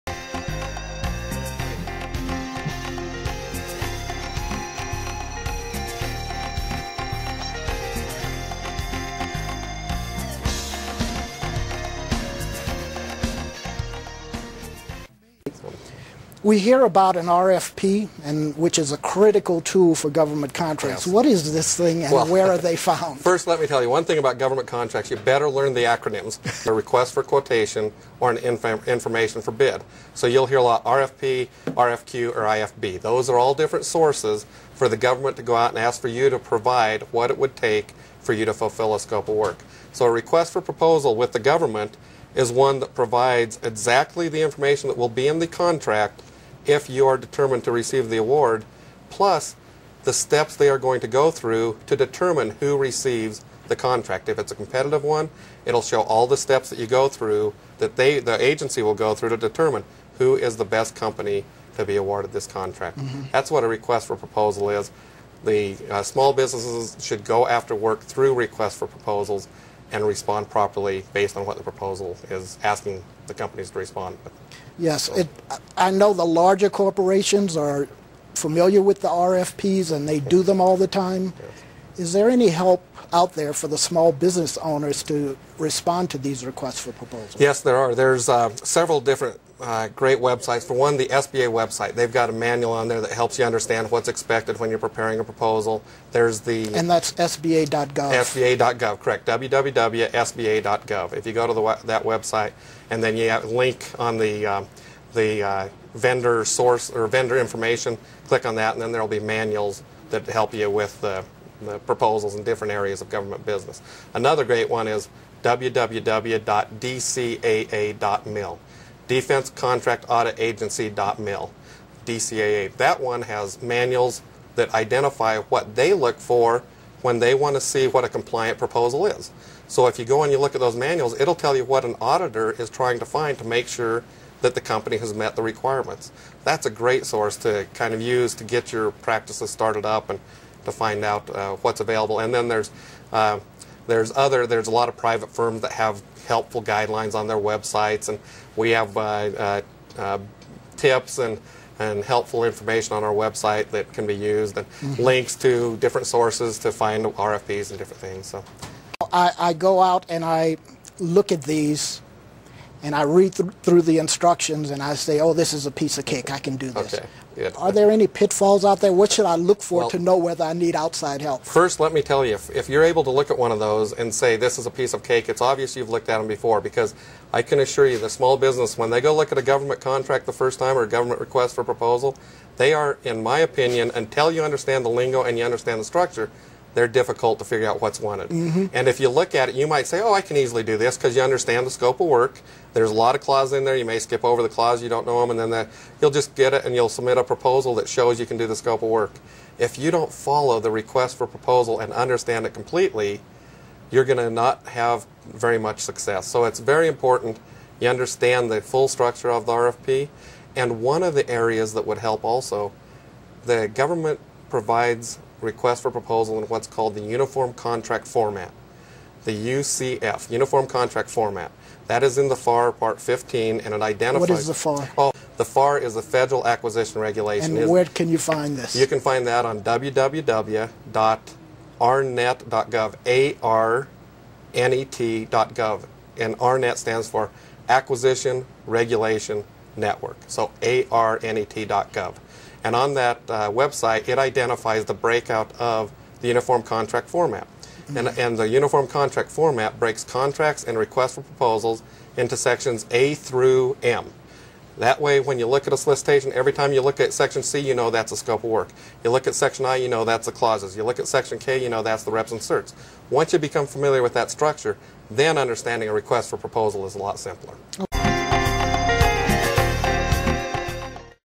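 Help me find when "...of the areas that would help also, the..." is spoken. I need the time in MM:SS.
03:31.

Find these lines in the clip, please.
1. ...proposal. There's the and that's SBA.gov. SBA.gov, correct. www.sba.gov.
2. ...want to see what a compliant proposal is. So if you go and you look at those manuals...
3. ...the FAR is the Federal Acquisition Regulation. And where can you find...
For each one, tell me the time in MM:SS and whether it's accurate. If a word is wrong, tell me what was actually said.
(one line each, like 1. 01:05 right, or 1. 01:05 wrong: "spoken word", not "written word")
1. 01:35 right
2. 02:07 right
3. 03:45 right.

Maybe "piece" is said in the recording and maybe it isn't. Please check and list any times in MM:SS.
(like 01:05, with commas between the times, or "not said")
02:45, 02:54.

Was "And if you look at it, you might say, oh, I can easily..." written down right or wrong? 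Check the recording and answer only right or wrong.
right.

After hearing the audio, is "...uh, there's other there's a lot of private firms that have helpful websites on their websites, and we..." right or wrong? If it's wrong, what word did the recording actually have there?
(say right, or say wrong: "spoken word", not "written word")
wrong: "guidelines", not "websites".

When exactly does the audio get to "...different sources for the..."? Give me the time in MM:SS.
00:33.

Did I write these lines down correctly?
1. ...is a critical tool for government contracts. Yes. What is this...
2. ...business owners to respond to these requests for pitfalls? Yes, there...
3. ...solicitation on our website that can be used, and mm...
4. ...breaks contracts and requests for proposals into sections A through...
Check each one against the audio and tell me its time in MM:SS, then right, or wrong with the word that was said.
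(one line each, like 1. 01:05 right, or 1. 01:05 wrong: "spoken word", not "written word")
1. 00:18 right
2. 01:24 wrong: "proposals", not "pitfalls"
3. 02:32 wrong: "information", not "solicitation"
4. 04:09 right.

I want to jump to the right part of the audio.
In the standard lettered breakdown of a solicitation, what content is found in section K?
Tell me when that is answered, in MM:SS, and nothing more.
04:22.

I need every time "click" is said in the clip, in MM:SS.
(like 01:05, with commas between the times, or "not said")
01:48.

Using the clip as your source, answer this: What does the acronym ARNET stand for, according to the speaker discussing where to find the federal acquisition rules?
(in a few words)
Acquisition Regulation Network.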